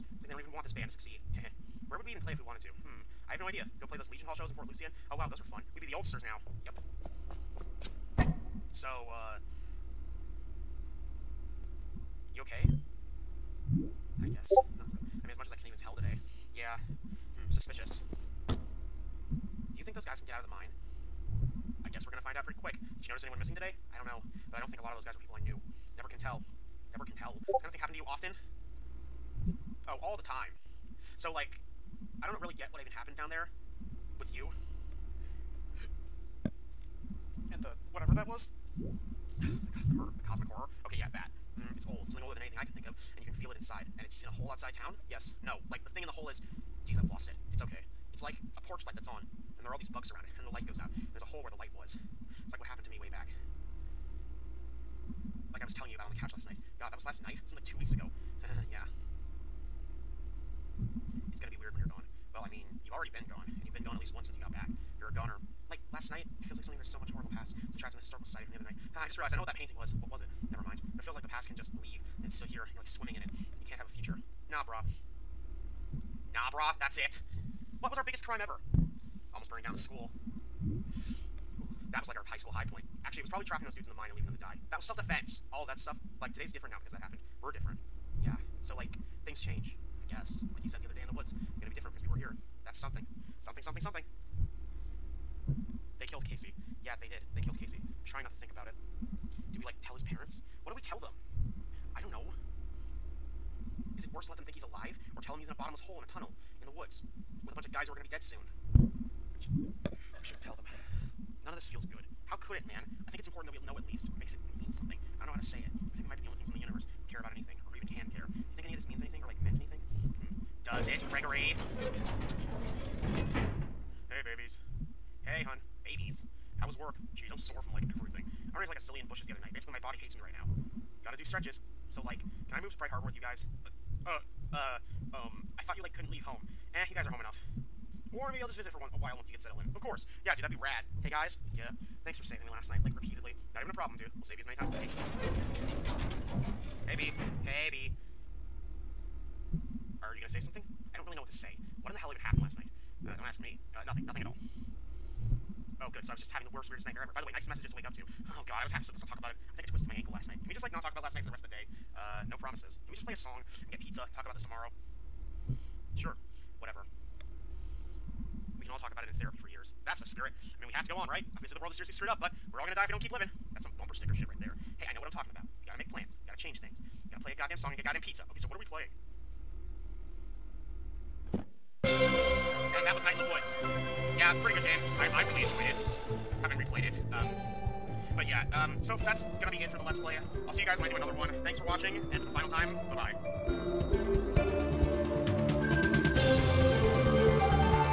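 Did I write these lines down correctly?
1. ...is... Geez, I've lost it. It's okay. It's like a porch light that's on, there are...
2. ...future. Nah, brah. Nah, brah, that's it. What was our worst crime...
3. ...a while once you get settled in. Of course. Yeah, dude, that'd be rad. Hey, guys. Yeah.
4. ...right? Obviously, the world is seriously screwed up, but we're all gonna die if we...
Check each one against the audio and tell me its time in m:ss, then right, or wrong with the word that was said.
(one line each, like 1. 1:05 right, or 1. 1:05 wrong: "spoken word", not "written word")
1. 0:46 right
2. 1:13 wrong: "biggest", not "worst"
3. 2:18 right
4. 2:51 right.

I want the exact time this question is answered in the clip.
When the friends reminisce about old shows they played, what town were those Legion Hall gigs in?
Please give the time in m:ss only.
0:04.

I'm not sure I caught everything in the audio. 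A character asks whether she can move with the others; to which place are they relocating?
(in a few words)
Bright Harbor.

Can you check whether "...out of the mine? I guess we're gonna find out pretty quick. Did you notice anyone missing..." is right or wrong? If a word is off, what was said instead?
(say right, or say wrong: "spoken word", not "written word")
right.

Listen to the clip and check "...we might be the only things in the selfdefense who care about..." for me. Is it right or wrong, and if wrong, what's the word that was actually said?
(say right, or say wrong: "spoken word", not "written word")
wrong: "universe", not "selfdefense".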